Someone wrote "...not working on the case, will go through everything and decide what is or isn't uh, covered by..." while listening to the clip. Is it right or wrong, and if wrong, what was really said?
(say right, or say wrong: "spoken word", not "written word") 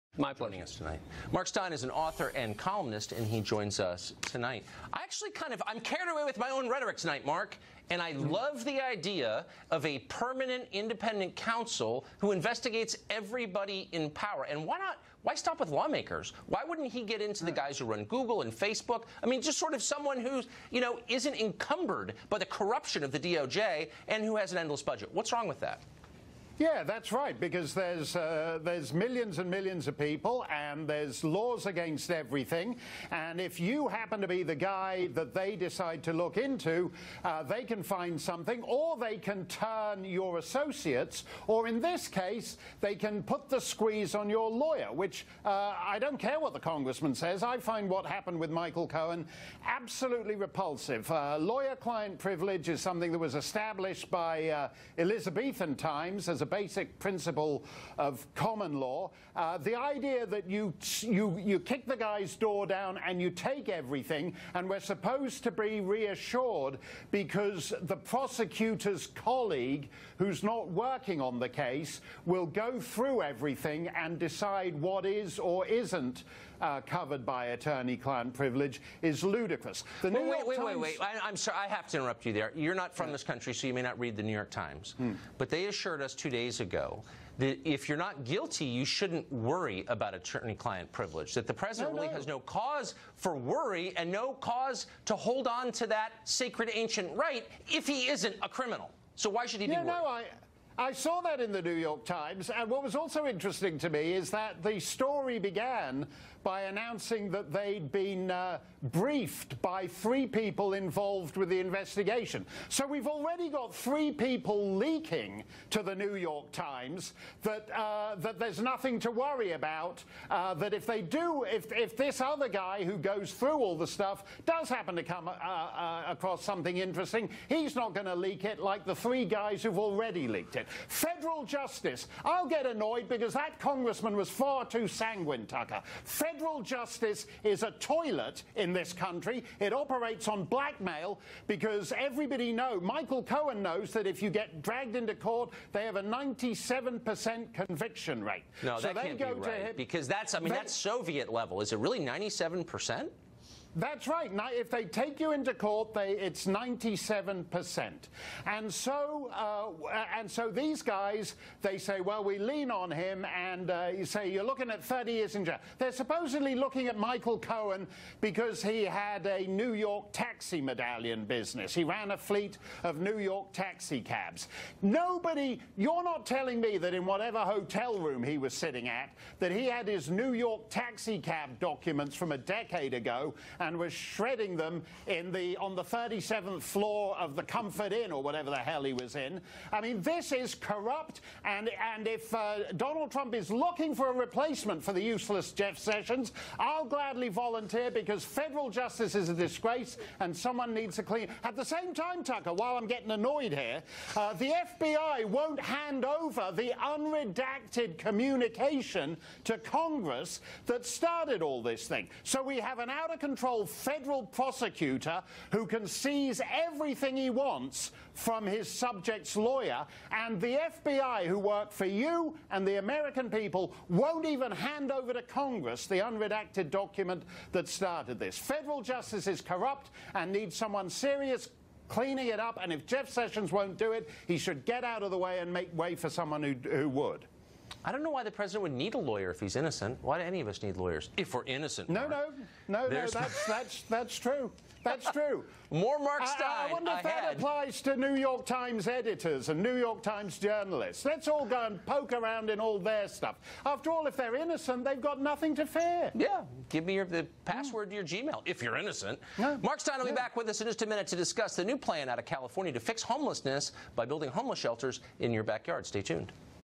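right.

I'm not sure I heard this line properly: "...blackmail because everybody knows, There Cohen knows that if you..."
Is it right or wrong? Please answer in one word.
wrong.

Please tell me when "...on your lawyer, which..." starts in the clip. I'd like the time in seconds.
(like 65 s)
44 s.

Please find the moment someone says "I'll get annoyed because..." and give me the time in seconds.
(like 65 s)
132 s.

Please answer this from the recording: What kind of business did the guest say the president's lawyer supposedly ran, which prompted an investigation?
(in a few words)
New York taxi medallion business.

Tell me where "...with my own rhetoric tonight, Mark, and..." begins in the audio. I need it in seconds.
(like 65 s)
6 s.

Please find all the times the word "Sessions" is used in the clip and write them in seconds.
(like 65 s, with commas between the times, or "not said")
195 s, 233 s.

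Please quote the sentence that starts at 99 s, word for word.
So why should he yeah, be worried?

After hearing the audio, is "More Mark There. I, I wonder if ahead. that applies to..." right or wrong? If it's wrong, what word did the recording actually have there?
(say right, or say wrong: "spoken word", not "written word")
wrong: "Steyn", not "There".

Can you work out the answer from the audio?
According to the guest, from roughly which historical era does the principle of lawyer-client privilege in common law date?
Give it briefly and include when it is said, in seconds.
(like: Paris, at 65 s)
Elizabethan times, at 54 s.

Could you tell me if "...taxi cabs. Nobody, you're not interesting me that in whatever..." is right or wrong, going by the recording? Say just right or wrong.
wrong.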